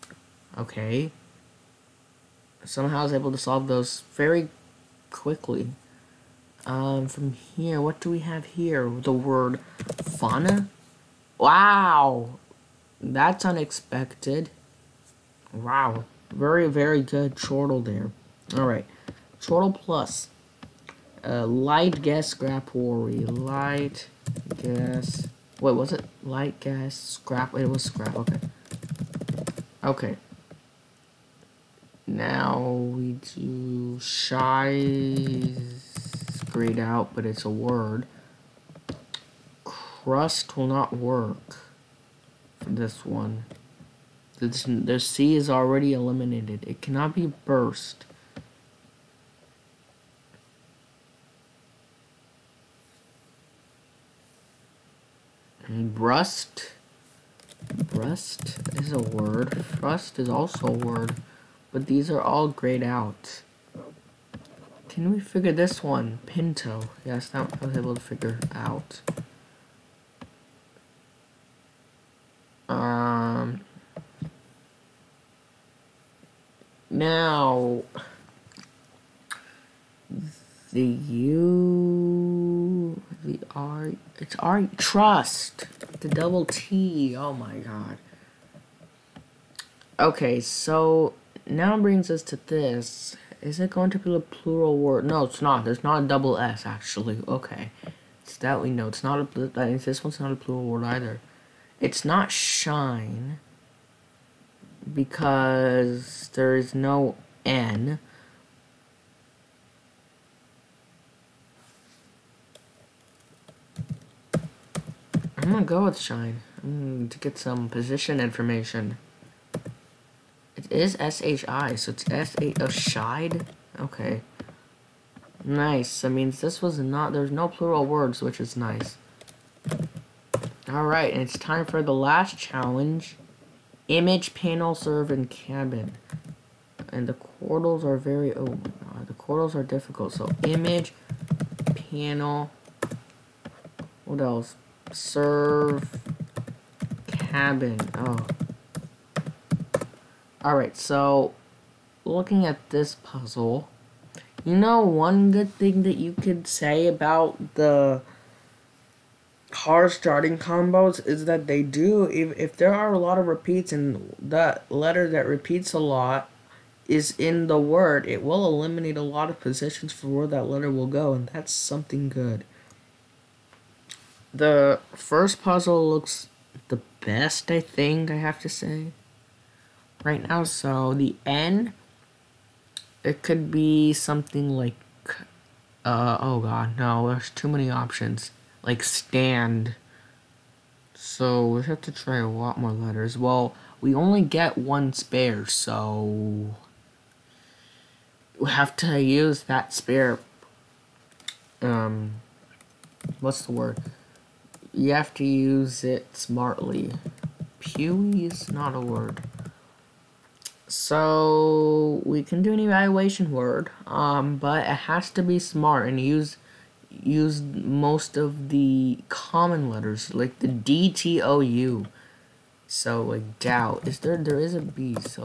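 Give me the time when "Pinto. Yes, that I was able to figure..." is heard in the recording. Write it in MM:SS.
01:06.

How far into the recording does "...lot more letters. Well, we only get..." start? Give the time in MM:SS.
03:12.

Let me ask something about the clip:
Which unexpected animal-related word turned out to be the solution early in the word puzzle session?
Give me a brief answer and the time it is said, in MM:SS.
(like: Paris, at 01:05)
fauna, at 00:10.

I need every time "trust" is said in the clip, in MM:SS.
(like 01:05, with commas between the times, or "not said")
01:24.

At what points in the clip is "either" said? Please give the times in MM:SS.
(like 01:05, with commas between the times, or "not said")
01:40.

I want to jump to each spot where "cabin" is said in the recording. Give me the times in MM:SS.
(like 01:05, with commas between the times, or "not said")
02:15, 02:27.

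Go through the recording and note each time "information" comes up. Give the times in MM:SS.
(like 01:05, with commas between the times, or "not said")
01:58.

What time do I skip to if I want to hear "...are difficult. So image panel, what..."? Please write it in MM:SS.
02:19.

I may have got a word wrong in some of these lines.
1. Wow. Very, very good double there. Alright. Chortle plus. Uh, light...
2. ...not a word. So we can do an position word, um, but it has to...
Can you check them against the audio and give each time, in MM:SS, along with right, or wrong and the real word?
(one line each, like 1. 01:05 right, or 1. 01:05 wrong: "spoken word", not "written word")
1. 00:15 wrong: "chortle", not "double"
2. 03:28 wrong: "evaluation", not "position".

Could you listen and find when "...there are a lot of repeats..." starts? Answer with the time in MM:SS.
02:42.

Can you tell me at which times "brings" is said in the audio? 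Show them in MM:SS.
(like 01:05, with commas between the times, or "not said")
01:31.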